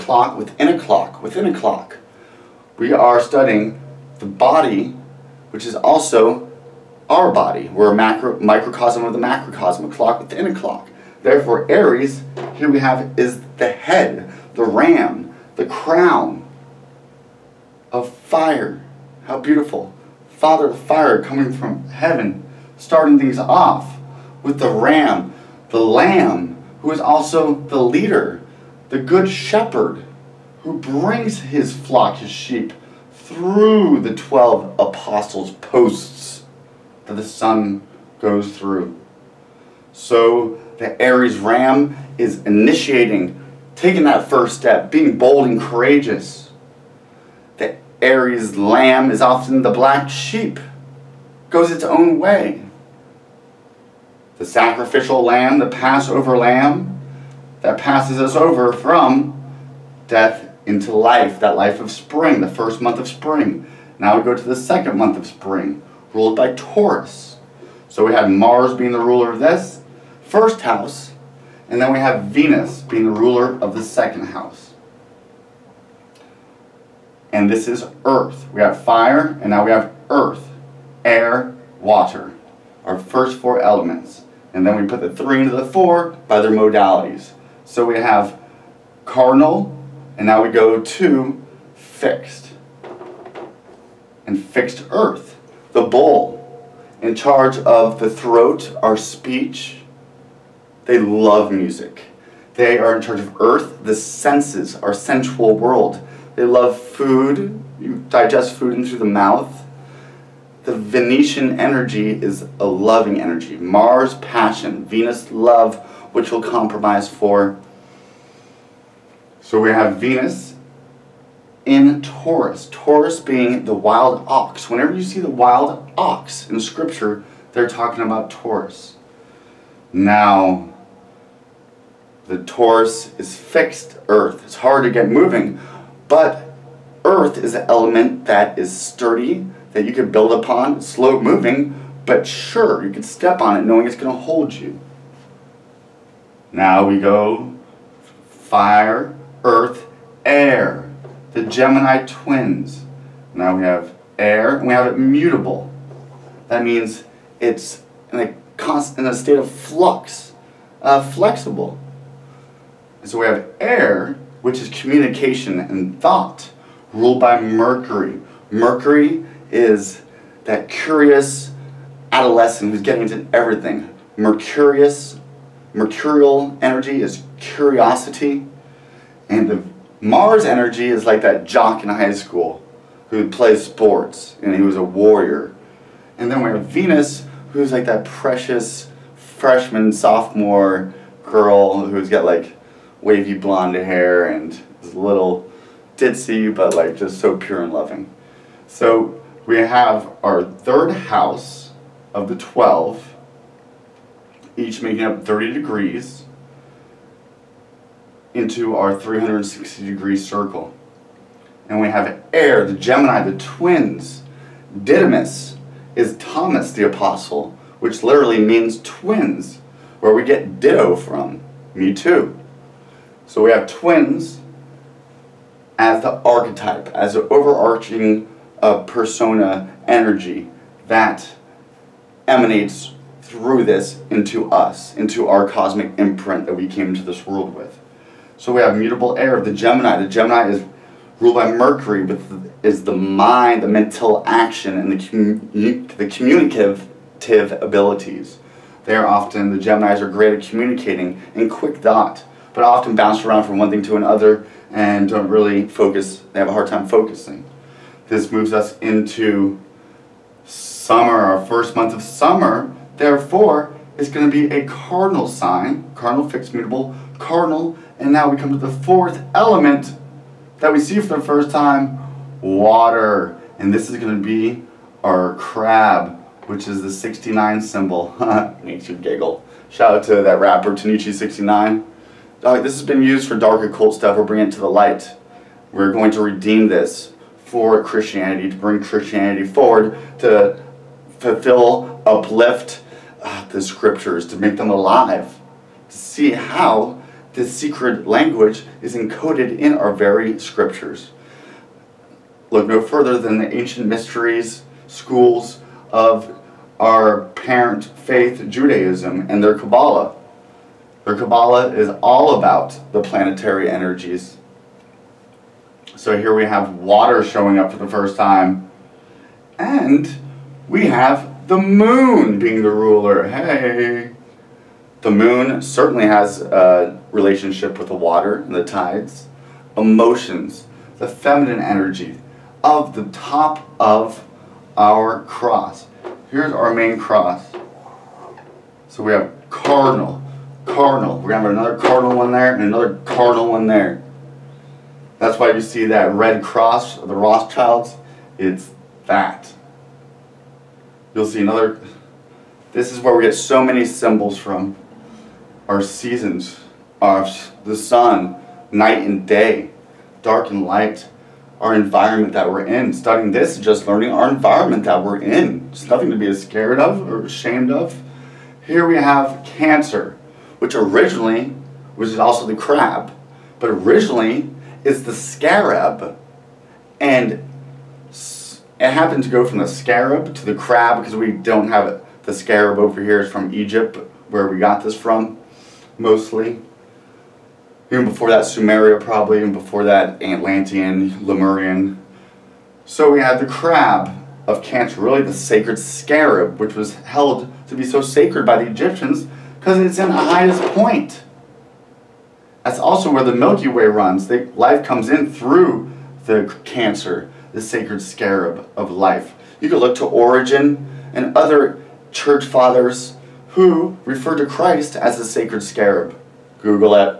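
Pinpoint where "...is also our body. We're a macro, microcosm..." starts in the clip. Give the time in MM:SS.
00:05.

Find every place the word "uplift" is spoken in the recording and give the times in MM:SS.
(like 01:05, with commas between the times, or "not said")
04:52.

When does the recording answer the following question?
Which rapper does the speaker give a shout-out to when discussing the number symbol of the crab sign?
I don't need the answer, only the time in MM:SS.
04:40.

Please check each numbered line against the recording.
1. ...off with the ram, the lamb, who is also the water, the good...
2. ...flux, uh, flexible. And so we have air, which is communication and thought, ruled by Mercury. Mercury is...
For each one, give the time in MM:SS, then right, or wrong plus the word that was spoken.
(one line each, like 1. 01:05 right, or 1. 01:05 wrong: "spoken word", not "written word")
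1. 00:23 wrong: "leader", not "water"
2. 02:39 right.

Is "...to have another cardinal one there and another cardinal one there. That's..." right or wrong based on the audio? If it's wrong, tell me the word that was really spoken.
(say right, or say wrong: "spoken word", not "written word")
right.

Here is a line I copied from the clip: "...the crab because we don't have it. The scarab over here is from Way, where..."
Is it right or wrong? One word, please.
wrong.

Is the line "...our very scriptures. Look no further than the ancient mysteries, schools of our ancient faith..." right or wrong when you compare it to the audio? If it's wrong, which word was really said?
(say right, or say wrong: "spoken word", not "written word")
wrong: "parent", not "ancient".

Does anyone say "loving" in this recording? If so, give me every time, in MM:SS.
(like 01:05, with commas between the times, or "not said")
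01:52, 03:17.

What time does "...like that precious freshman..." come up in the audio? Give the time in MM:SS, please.
03:07.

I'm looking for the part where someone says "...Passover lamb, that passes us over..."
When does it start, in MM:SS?
00:55.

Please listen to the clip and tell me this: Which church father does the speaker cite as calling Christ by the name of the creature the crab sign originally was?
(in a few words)
Origen.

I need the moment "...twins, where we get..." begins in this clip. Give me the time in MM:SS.
03:38.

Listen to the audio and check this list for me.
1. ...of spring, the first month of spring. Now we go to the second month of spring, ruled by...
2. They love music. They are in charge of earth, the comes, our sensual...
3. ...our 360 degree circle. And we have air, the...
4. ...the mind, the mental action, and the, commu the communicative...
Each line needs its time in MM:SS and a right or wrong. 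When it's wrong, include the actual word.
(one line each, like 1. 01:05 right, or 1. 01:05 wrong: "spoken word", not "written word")
1. 01:01 right
2. 01:40 wrong: "senses", not "comes"
3. 03:28 right
4. 04:02 right.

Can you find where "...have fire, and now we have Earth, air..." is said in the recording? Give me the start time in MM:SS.
01:18.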